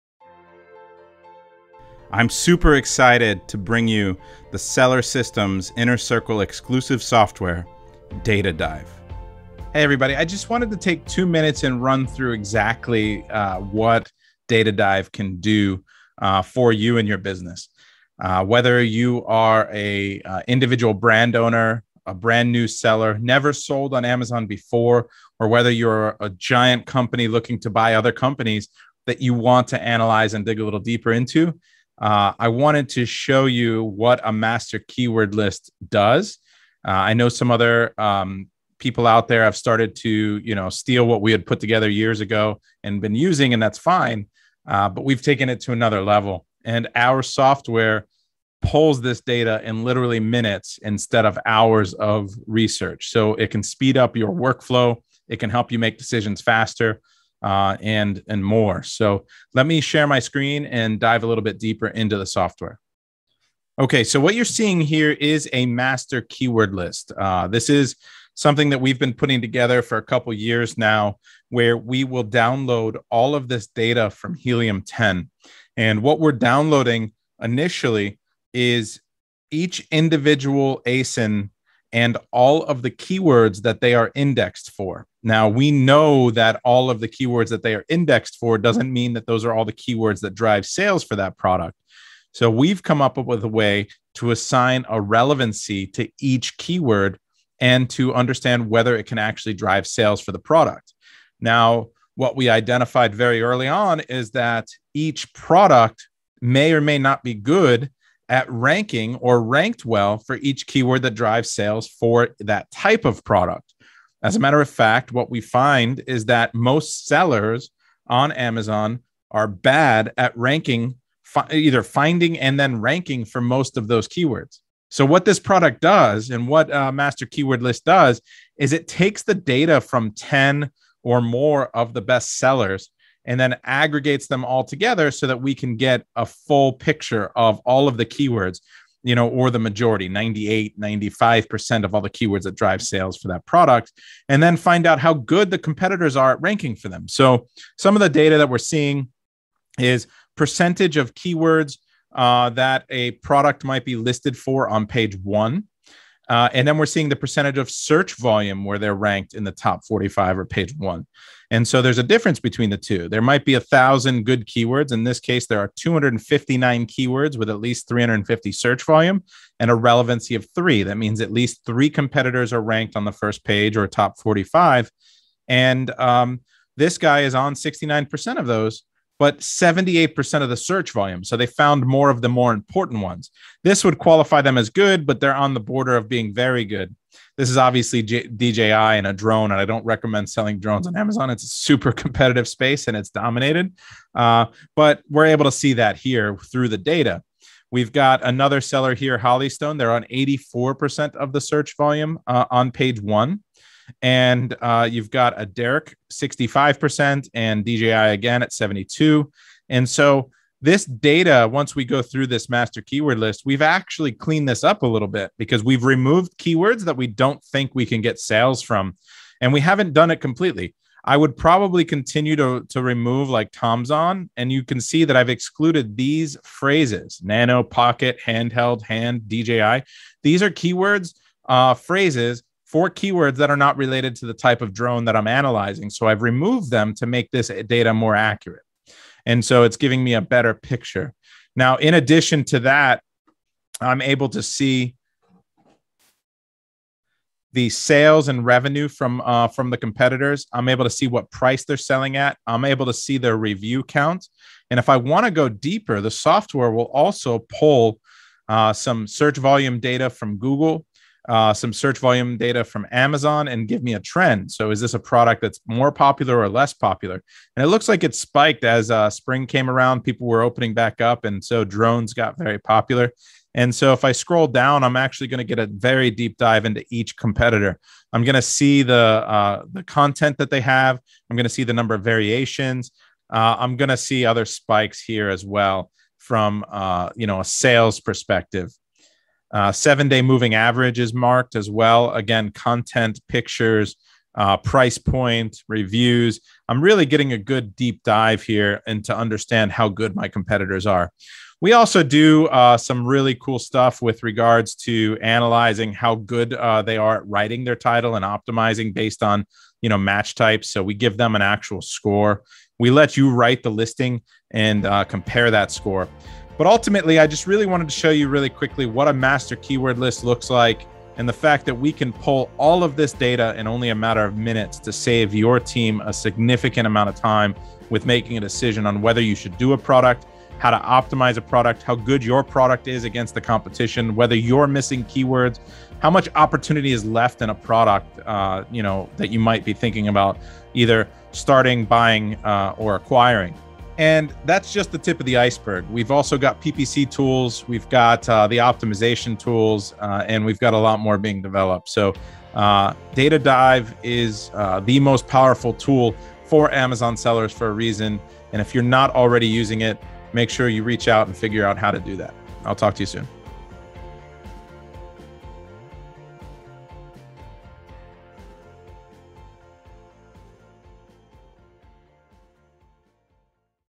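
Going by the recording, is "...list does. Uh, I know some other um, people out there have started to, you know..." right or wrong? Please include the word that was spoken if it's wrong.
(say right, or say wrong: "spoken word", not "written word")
right.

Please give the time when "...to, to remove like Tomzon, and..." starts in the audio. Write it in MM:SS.
03:42.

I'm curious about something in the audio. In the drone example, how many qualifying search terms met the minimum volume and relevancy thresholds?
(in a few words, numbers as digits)
259.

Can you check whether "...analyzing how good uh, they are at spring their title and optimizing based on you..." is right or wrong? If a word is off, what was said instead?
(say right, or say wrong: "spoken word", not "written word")
wrong: "writing", not "spring".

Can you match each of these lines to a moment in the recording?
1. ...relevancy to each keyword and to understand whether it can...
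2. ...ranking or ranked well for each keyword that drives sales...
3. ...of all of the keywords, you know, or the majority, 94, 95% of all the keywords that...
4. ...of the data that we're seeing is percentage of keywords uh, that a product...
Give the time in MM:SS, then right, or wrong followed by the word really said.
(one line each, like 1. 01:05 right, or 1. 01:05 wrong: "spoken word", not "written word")
1. 01:35 right
2. 01:48 right
3. 02:17 wrong: "98", not "94"
4. 02:27 right.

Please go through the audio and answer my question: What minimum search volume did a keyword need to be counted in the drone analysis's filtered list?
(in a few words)
350.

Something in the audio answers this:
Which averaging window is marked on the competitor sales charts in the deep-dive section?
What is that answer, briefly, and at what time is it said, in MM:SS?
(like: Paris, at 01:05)
seven day, at 04:49.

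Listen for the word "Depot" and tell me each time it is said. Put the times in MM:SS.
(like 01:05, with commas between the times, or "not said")
not said.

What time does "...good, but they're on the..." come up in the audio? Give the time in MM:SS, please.
03:04.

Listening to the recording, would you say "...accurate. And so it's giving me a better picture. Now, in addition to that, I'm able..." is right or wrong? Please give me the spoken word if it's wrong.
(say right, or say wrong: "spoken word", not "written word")
right.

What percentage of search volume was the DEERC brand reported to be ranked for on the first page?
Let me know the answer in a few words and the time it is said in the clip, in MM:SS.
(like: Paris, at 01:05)
65%, at 03:26.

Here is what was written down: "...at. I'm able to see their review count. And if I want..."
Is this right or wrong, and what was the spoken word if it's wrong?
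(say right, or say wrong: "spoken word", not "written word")
right.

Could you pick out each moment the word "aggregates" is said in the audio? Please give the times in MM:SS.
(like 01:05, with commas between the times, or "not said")
02:13.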